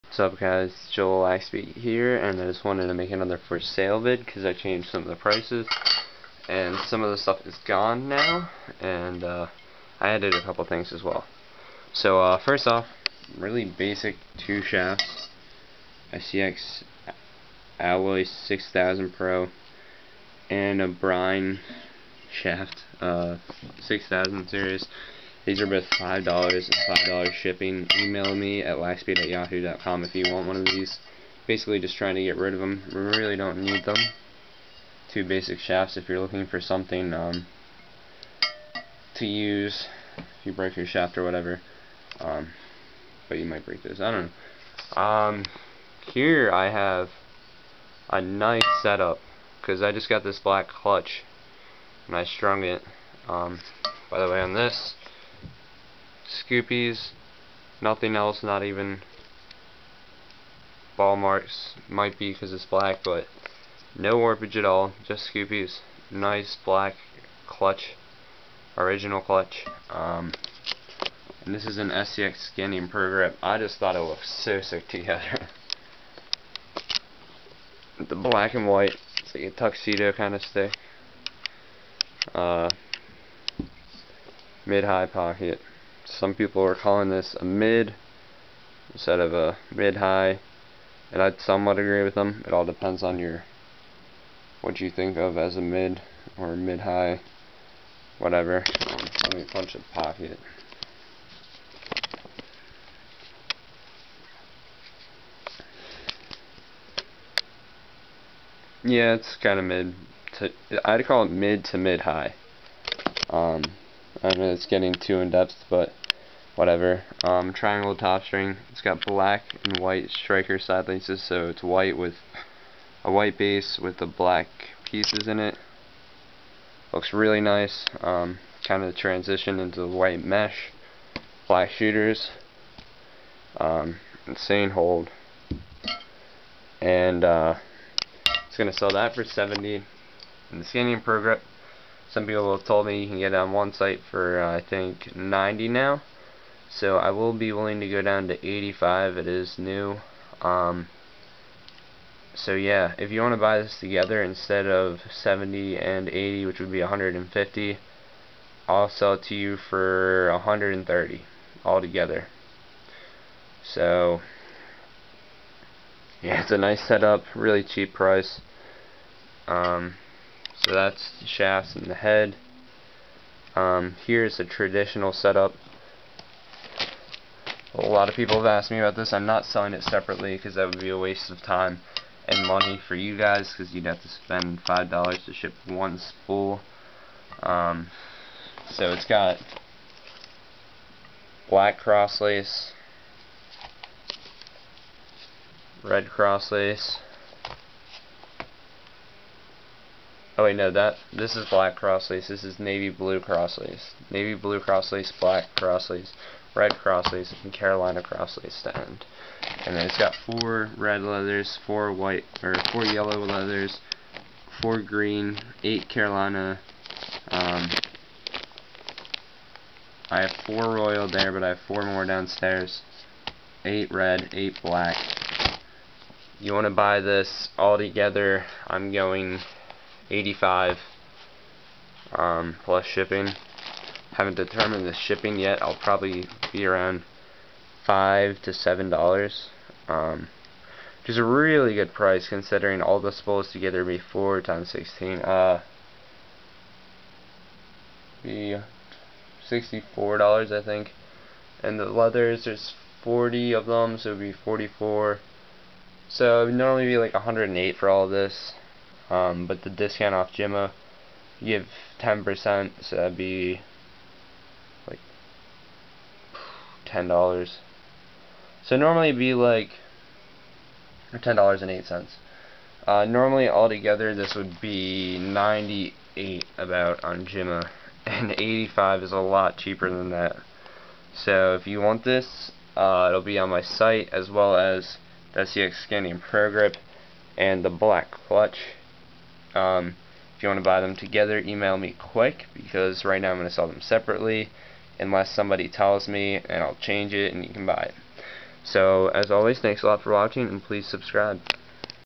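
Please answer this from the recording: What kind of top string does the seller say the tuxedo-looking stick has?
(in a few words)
triangle top string.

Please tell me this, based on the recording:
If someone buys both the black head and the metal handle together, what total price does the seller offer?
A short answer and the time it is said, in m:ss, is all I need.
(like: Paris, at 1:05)
$130, at 2:40.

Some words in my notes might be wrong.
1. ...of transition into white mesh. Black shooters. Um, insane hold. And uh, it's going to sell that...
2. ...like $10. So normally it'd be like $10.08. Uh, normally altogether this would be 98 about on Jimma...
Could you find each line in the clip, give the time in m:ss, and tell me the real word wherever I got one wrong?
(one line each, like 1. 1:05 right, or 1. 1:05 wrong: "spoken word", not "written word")
1. 2:08 right
2. 4:24 right.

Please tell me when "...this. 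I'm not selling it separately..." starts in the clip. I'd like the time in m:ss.
2:58.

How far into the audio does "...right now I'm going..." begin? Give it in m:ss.
4:53.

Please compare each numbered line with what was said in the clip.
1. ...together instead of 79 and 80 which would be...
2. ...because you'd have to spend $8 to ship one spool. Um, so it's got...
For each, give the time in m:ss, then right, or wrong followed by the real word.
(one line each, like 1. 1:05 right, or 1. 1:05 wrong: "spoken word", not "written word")
1. 2:33 wrong: "70", not "79"
2. 3:03 wrong: "5", not "8".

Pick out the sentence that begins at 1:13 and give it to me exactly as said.
I just thought it looked so sick together.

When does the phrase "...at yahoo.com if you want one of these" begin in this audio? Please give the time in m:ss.
0:29.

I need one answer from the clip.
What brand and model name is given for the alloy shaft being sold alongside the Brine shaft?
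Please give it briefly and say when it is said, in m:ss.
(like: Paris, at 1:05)
ICX Alloy 6000 Pro, at 0:16.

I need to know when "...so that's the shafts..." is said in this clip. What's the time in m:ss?
2:50.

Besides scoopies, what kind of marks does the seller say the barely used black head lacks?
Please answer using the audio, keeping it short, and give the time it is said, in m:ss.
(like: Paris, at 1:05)
ball marks, at 1:00.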